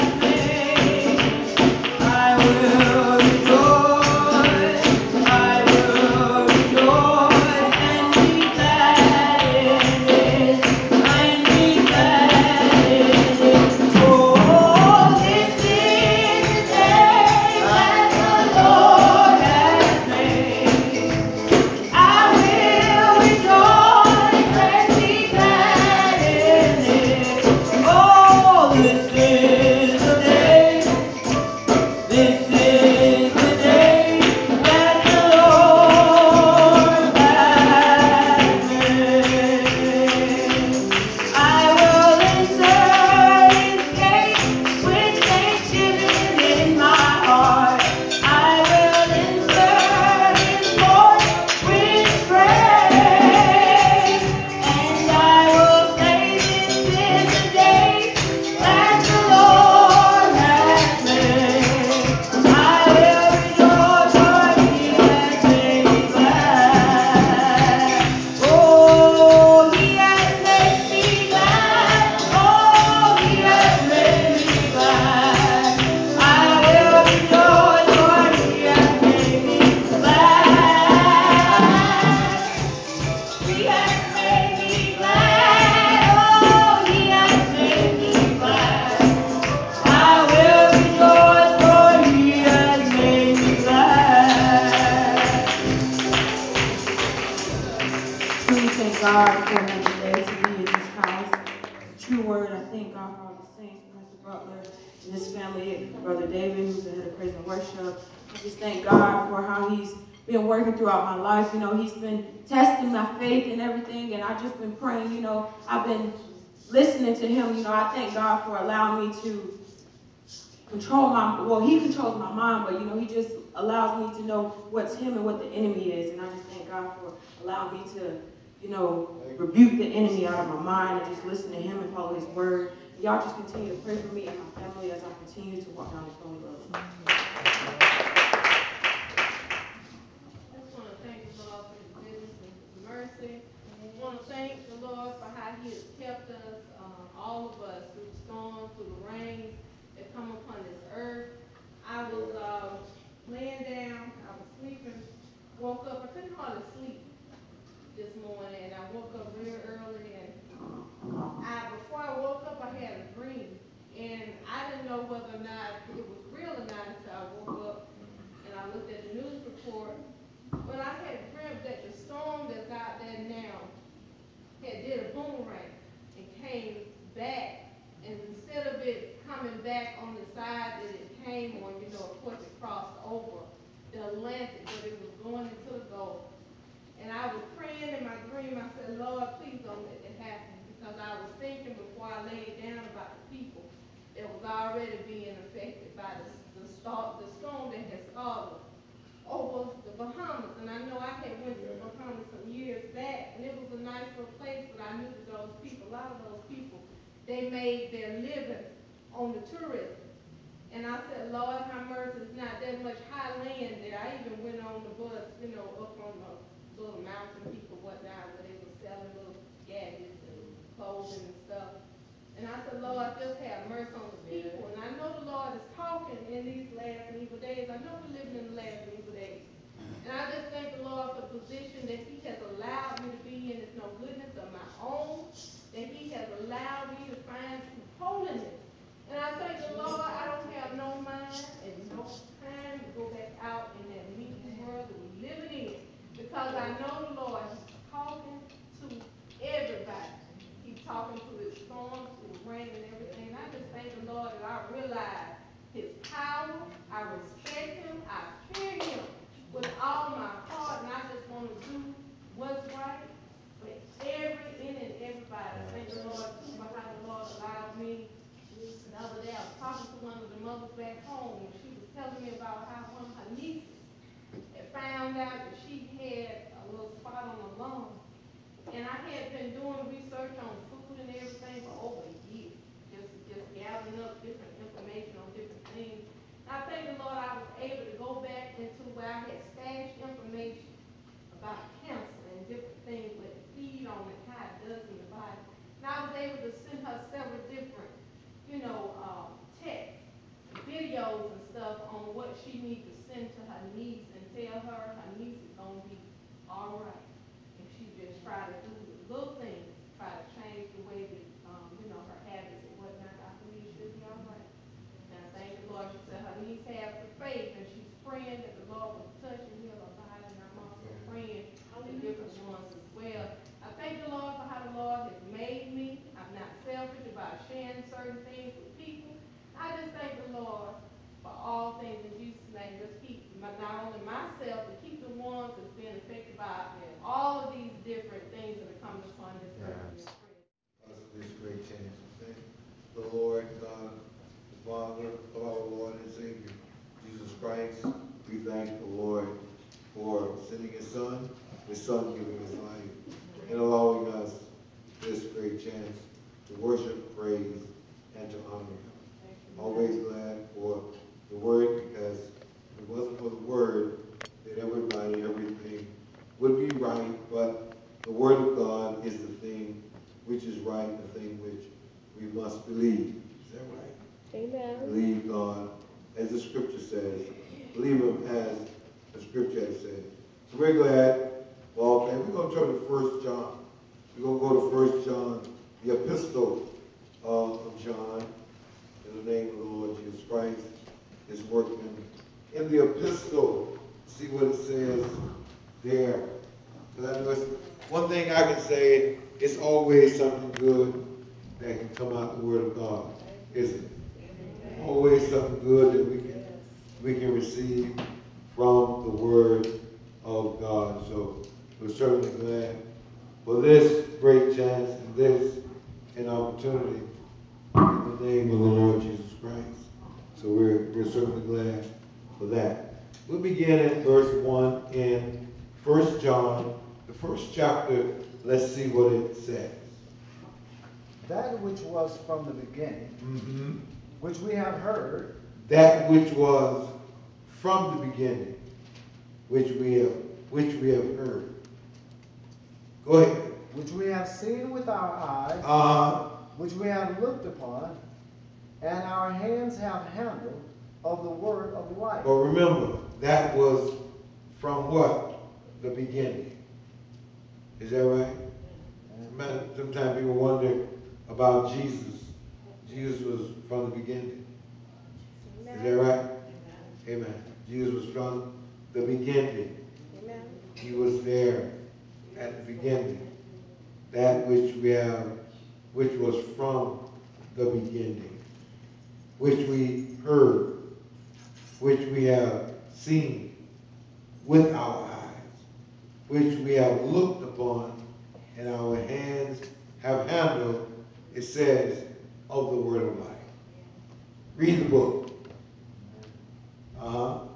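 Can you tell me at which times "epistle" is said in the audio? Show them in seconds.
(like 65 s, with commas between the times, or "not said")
385 s, 392 s.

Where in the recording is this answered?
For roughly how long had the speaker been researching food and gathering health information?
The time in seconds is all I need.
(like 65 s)
281 s.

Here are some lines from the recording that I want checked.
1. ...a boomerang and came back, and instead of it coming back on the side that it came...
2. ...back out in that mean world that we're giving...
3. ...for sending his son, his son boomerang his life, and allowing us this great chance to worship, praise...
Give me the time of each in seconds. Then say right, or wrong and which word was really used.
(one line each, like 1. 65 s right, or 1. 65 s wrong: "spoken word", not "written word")
1. 175 s right
2. 243 s wrong: "living", not "giving"
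3. 349 s wrong: "giving", not "boomerang".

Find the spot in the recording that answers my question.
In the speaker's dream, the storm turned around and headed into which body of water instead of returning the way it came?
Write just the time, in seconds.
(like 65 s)
185 s.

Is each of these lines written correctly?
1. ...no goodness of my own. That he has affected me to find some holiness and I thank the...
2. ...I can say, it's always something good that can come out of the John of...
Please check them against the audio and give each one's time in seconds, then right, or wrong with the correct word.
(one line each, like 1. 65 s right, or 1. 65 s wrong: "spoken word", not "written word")
1. 233 s wrong: "allowed", not "affected"
2. 398 s wrong: "Word", not "John".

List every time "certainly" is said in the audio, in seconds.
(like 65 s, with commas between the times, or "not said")
411 s, 421 s.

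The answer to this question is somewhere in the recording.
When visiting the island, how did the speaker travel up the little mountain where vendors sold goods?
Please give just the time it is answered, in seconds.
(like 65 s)
214 s.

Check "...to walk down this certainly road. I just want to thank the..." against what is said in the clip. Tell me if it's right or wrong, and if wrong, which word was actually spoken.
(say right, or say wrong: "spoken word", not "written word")
wrong: "lonely", not "certainly".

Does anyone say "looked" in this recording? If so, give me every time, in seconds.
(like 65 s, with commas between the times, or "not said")
168 s, 447 s, 487 s.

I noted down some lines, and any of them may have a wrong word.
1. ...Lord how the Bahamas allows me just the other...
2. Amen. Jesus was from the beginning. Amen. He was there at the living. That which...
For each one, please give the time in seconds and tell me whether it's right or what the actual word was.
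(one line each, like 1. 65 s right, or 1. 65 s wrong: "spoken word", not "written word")
1. 266 s wrong: "Lord", not "Bahamas"
2. 467 s wrong: "beginning", not "living".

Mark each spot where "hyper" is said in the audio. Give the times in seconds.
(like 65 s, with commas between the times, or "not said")
not said.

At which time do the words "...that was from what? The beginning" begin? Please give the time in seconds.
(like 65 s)
453 s.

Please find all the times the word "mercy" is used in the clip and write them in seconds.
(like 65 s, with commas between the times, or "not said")
142 s, 211 s, 223 s.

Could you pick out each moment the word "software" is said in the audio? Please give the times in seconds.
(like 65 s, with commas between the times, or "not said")
not said.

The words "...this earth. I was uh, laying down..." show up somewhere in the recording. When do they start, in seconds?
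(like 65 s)
150 s.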